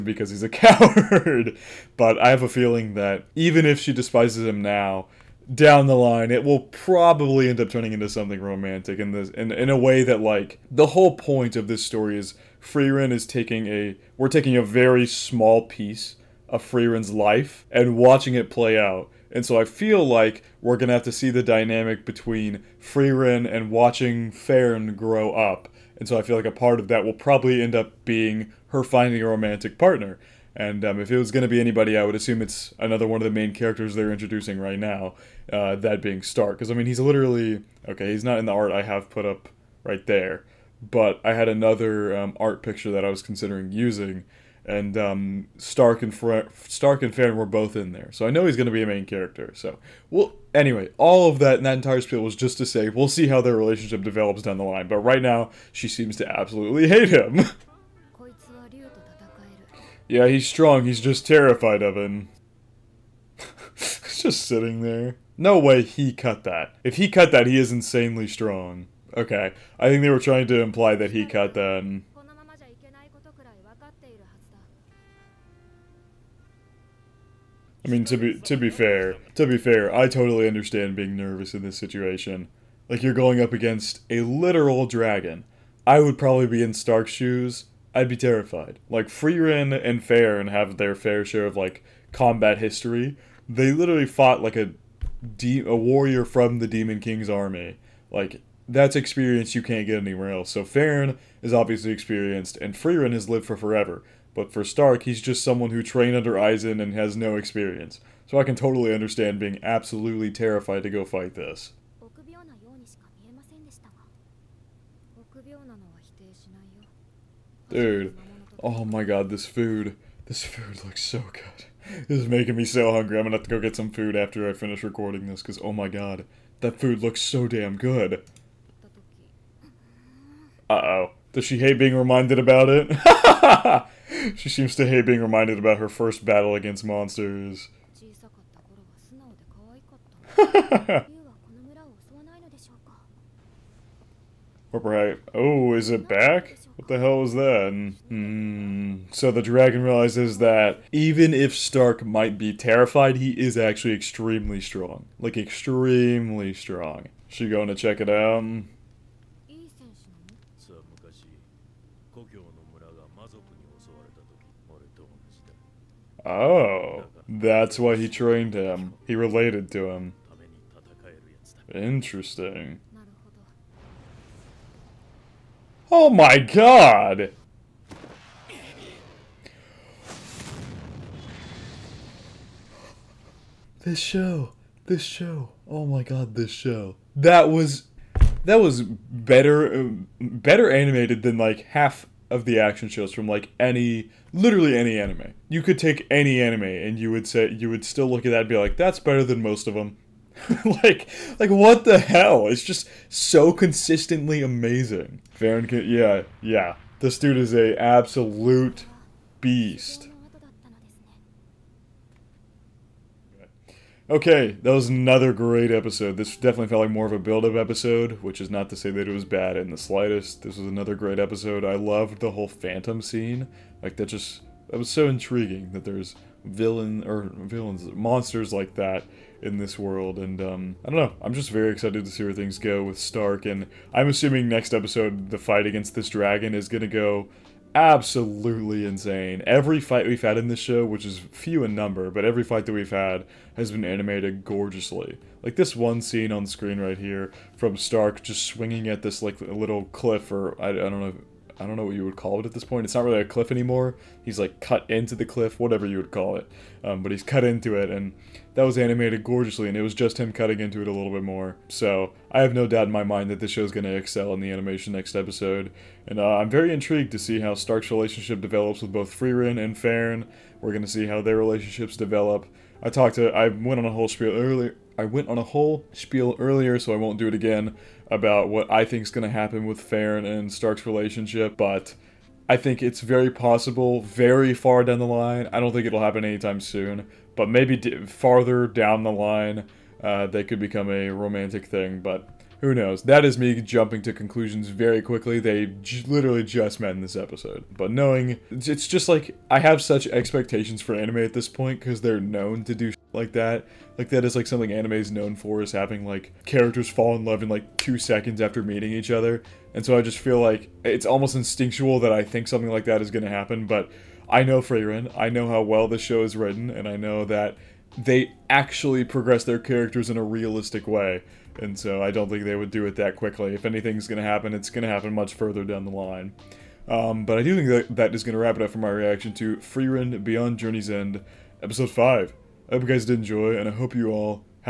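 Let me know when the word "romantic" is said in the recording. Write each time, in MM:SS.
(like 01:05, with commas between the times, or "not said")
00:08, 00:29, 04:51.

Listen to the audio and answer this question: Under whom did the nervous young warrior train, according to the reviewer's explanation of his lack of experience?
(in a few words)
Eisen.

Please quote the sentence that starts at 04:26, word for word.
And uh, I'm very intrigued to see how Stark's relationship develops with both Frieren and Fern.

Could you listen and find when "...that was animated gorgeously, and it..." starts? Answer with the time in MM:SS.
04:18.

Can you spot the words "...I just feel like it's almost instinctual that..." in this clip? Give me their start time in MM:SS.
05:09.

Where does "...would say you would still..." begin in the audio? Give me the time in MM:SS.
03:17.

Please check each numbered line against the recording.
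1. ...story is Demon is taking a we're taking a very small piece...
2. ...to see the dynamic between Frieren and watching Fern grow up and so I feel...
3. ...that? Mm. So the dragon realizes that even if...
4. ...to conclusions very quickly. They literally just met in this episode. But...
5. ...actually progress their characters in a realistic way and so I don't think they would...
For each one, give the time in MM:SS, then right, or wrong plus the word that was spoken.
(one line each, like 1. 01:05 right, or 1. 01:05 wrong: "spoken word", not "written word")
1. 00:11 wrong: "Frieren", not "Demon"
2. 00:21 right
3. 02:27 right
4. 04:54 right
5. 05:18 right.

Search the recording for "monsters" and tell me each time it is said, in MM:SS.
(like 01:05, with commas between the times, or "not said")
02:16, 03:47.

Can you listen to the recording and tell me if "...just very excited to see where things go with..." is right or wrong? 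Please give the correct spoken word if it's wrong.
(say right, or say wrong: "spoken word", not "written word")
right.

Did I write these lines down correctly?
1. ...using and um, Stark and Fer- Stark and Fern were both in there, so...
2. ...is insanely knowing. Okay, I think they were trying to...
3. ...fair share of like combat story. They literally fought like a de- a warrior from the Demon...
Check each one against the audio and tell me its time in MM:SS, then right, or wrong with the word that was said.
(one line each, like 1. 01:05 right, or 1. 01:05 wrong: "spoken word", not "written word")
1. 00:43 right
2. 01:07 wrong: "strong", not "knowing"
3. 01:30 wrong: "history", not "story".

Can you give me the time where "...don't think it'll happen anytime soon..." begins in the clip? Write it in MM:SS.
04:45.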